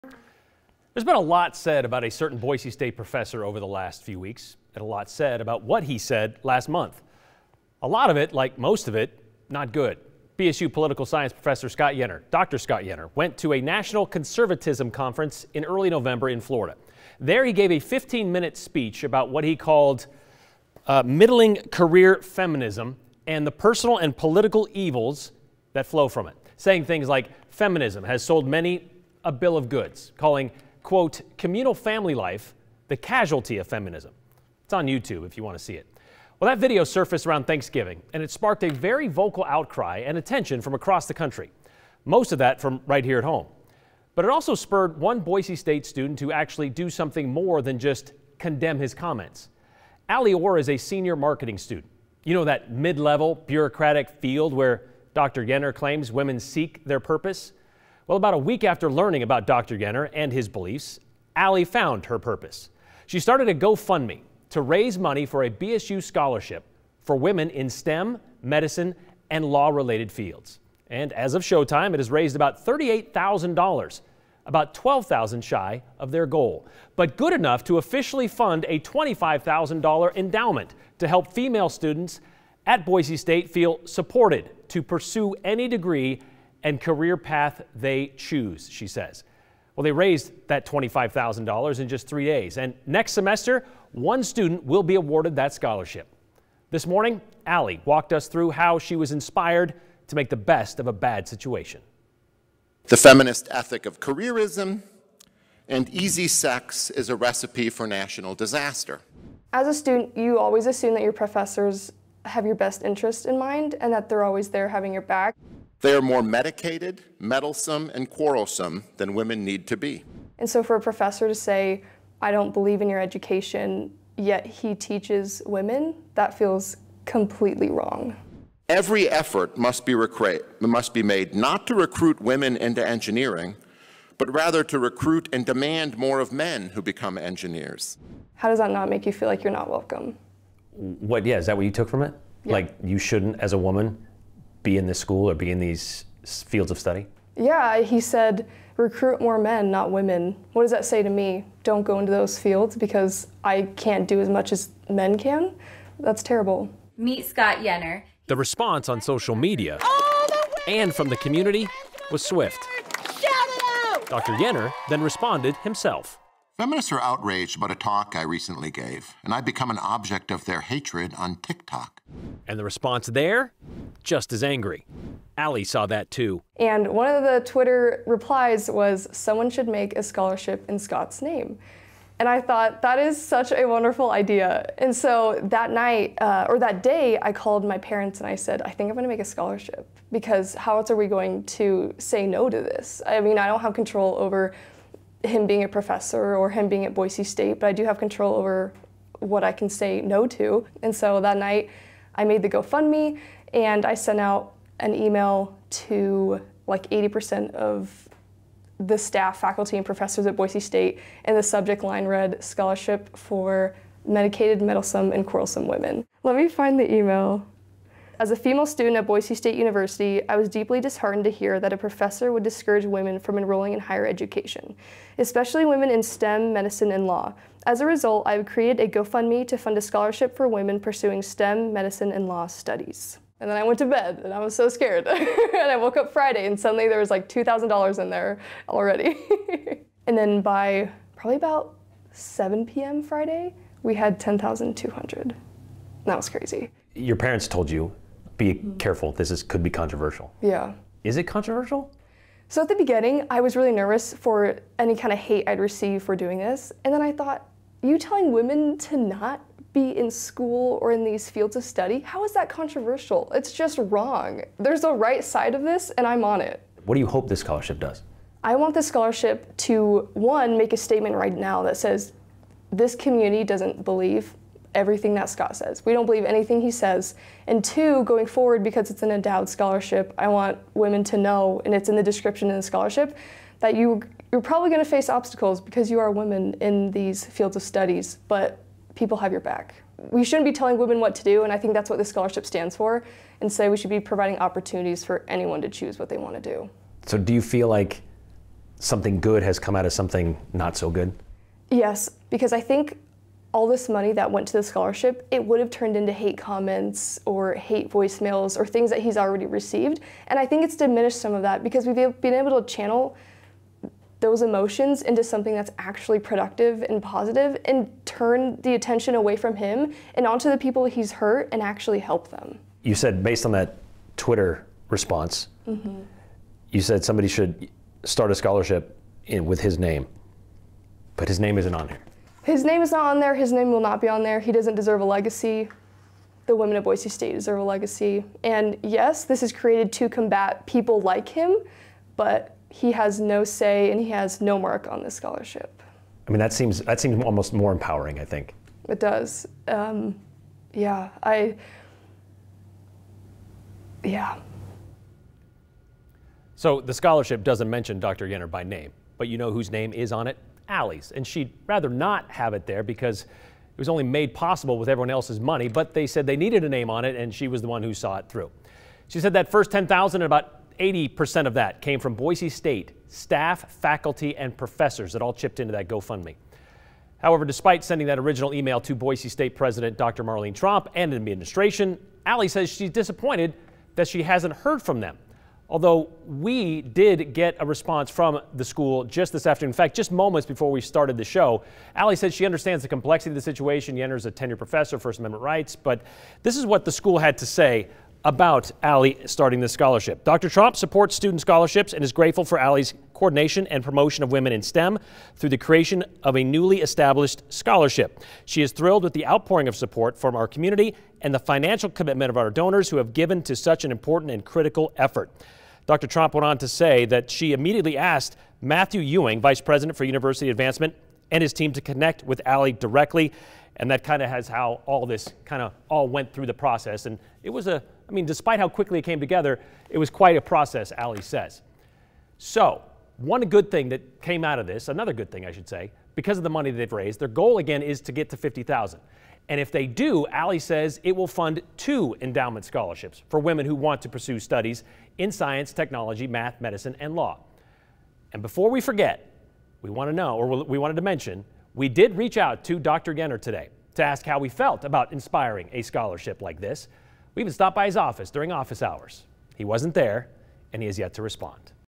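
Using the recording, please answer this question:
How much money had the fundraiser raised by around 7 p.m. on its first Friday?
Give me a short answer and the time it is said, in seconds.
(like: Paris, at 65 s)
10,200, at 244 s.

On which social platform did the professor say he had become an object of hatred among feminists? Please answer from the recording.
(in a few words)
TikTok.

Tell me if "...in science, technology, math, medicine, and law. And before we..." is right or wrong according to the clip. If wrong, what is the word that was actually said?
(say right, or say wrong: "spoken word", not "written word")
right.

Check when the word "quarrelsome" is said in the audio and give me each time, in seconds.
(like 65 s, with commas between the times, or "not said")
118 s, 215 s.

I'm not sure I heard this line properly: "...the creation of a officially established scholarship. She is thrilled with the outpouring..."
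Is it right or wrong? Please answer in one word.
wrong.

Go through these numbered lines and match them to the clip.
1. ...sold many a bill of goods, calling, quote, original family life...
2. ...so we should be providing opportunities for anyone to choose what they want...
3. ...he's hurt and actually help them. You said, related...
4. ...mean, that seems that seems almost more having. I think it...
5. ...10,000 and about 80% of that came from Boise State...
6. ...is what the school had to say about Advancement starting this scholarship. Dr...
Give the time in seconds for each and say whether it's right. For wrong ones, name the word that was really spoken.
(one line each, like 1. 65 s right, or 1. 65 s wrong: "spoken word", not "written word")
1. 28 s wrong: "communal", not "original"
2. 293 s right
3. 320 s wrong: "based", not "related"
4. 346 s wrong: "empowering", not "having"
5. 369 s right
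6. 396 s wrong: "Ally", not "Advancement".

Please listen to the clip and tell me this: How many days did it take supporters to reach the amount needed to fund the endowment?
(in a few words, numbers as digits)
3.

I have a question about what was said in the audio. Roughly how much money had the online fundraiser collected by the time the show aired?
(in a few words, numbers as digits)
$38,000.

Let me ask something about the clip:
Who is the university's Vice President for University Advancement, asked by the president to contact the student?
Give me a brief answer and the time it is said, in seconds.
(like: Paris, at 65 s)
Matthew Ewing, at 418 s.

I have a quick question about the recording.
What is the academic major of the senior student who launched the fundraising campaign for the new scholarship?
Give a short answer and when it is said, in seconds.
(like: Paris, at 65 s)
Marketing, at 51 s.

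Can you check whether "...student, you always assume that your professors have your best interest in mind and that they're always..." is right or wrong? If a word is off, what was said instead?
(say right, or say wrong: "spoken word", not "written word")
right.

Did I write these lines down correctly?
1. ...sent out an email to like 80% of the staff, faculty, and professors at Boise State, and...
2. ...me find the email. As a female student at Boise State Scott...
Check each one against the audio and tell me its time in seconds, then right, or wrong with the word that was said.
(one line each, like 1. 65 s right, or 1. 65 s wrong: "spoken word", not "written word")
1. 203 s right
2. 216 s wrong: "University", not "Scott".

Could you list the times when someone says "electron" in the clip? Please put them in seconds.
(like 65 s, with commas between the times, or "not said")
not said.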